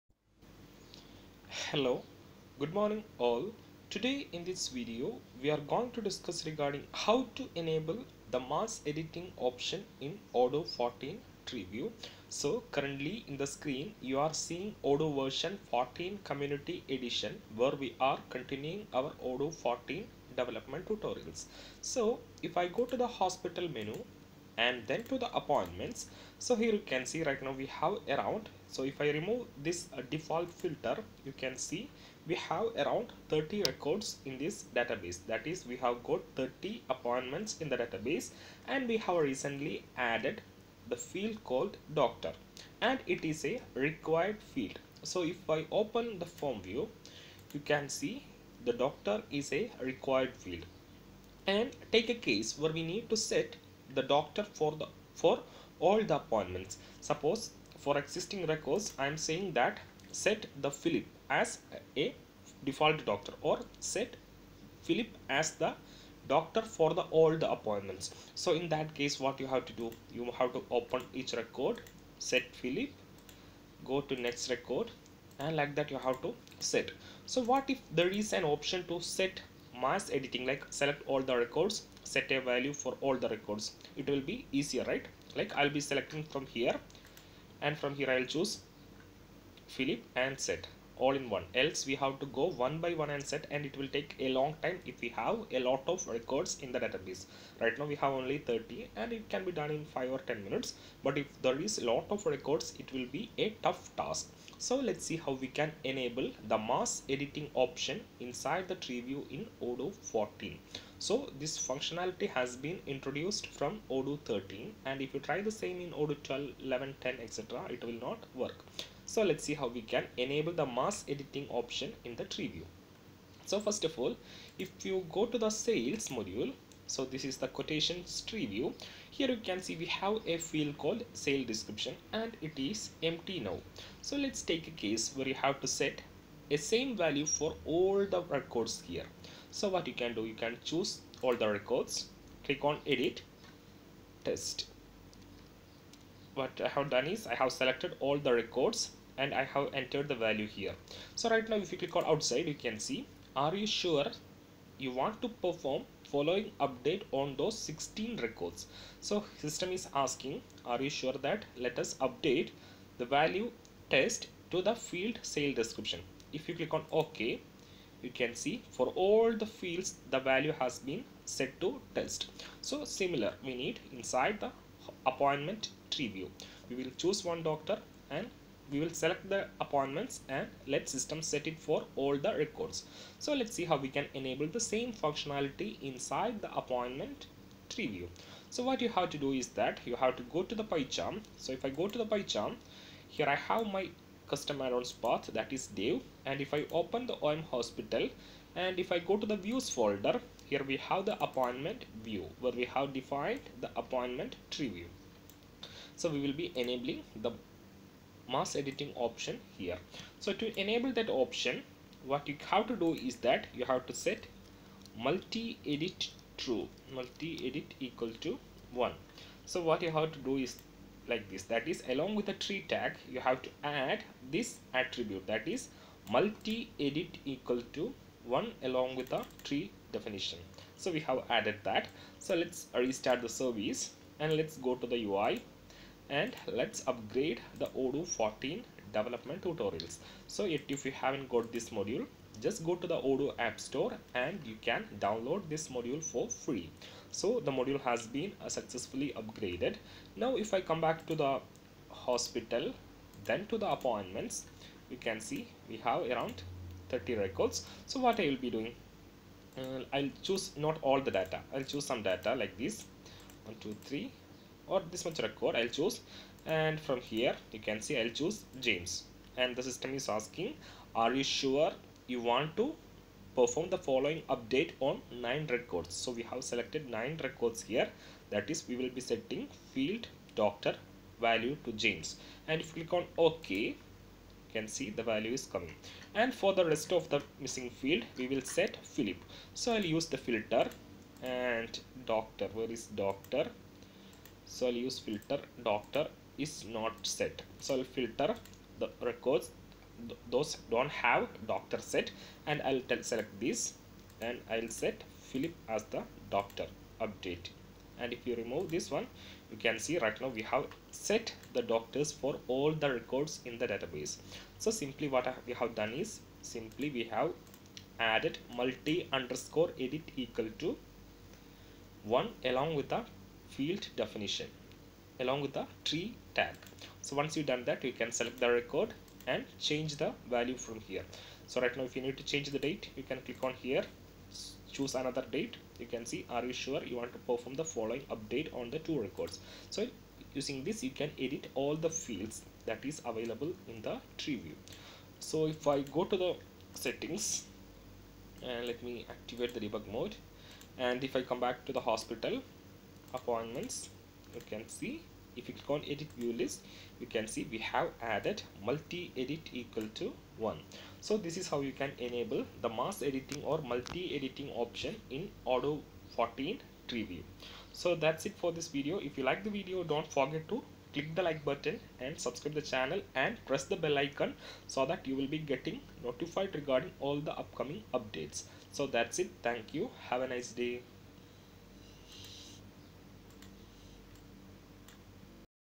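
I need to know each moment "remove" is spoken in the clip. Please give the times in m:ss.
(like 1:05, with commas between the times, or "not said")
0:29, 5:08.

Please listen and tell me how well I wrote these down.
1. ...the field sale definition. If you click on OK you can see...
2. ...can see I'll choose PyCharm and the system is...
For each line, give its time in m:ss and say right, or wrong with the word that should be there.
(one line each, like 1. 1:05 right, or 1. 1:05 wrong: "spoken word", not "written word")
1. 2:44 wrong: "description", not "definition"
2. 4:27 wrong: "James", not "PyCharm".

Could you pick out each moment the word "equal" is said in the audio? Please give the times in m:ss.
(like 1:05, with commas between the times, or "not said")
3:37, 3:47, 5:20, 5:59.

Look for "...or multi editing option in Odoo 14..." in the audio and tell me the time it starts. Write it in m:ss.
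6:03.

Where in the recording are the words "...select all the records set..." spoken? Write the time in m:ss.
1:20.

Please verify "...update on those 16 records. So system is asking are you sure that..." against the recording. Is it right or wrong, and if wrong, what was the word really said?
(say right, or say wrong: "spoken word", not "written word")
right.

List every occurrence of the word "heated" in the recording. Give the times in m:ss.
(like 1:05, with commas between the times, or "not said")
not said.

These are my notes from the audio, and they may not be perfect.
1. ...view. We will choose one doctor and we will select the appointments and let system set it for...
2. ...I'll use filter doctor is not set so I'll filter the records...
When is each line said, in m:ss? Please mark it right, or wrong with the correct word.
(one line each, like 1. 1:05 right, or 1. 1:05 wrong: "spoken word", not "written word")
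1. 2:56 right
2. 4:54 right.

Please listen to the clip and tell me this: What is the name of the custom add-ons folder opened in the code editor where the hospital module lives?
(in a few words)
Dev.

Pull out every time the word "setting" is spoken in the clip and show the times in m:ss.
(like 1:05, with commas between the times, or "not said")
4:39, 5:46.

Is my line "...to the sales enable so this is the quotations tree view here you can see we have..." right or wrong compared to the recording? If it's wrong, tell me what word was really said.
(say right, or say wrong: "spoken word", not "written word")
wrong: "module", not "enable".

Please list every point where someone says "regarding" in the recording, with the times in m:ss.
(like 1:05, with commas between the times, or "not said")
0:06, 6:16.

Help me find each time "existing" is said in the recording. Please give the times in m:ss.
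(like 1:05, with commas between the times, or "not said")
0:58.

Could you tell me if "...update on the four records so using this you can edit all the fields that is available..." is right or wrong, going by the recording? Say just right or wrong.
wrong.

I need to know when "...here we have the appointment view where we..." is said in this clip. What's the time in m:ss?
3:20.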